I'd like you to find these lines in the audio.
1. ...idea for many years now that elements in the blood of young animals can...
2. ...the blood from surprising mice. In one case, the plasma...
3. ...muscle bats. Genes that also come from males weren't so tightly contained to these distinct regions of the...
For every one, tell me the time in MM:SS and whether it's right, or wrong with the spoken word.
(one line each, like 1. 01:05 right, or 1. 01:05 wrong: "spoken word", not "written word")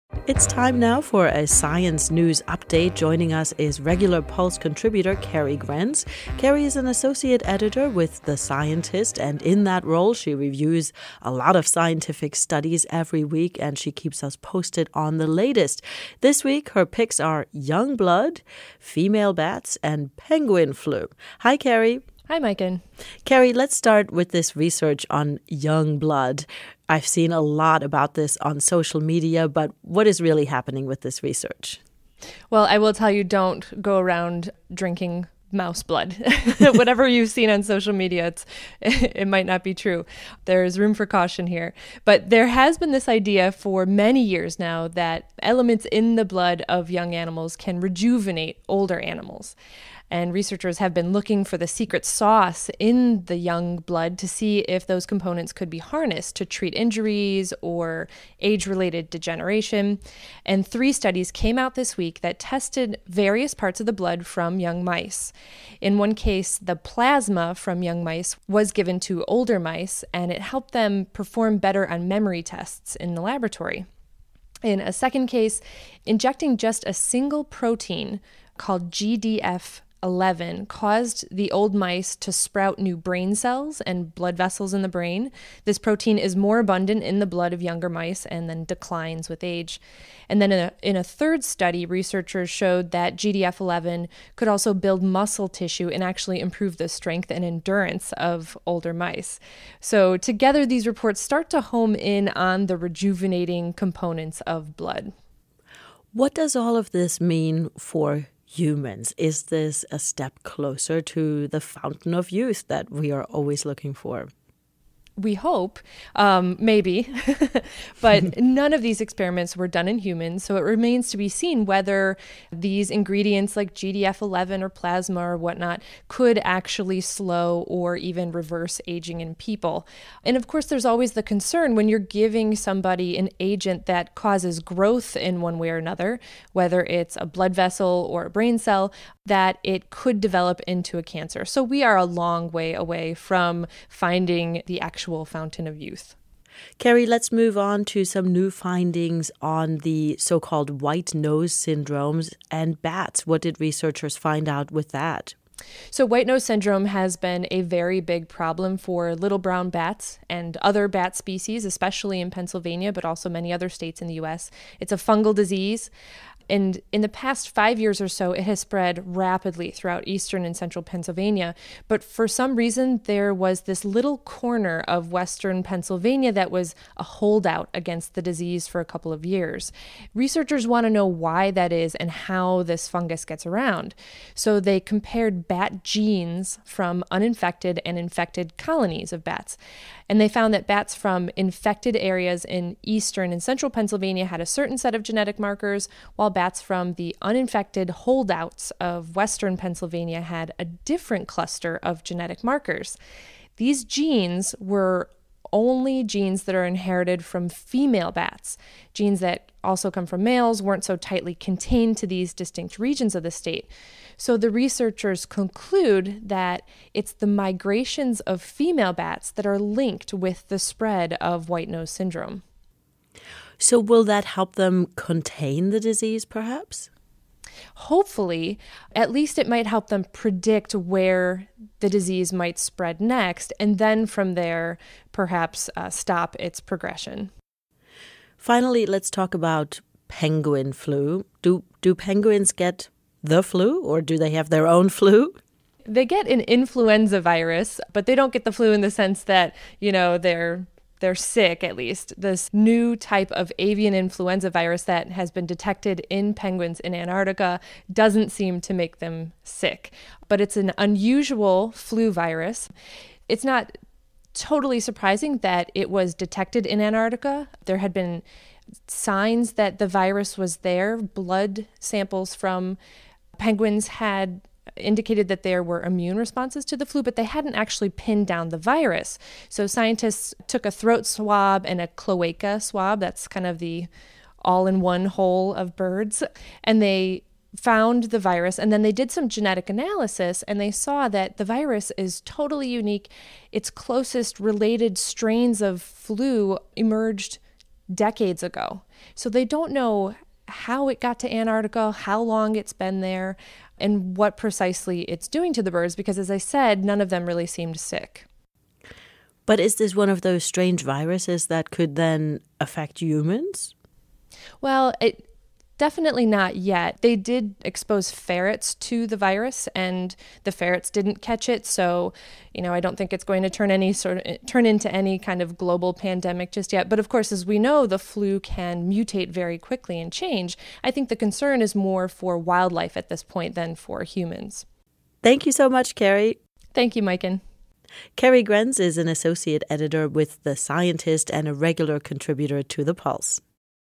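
1. 00:43 right
2. 01:03 wrong: "young", not "surprising"
3. 03:27 wrong: "female", not "muscle".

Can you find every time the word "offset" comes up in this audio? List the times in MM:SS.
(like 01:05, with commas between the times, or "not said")
not said.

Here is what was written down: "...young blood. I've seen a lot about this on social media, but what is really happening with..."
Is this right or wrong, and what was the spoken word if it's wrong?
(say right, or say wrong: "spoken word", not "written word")
right.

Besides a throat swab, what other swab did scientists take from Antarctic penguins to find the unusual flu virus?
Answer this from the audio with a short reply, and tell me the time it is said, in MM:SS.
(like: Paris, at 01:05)
Cloaca swab, at 04:41.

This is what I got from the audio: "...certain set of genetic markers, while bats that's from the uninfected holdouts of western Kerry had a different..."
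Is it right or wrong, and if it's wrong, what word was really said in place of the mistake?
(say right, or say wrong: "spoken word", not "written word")
wrong: "Pennsylvania", not "Kerry".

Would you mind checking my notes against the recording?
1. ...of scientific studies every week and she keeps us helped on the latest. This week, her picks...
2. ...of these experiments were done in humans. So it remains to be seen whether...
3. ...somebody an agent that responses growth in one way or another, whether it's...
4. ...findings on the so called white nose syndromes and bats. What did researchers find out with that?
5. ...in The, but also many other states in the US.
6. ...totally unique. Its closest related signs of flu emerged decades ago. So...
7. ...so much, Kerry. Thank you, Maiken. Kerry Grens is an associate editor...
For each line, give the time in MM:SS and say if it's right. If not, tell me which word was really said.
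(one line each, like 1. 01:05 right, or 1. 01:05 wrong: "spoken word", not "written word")
1. 00:11 wrong: "posted", not "helped"
2. 01:58 right
3. 02:12 wrong: "causes", not "responses"
4. 02:28 right
5. 02:42 wrong: "Pennsylvania", not "The"
6. 04:52 wrong: "strains", not "signs"
7. 05:35 right.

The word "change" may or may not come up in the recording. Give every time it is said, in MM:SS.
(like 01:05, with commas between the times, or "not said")
05:30.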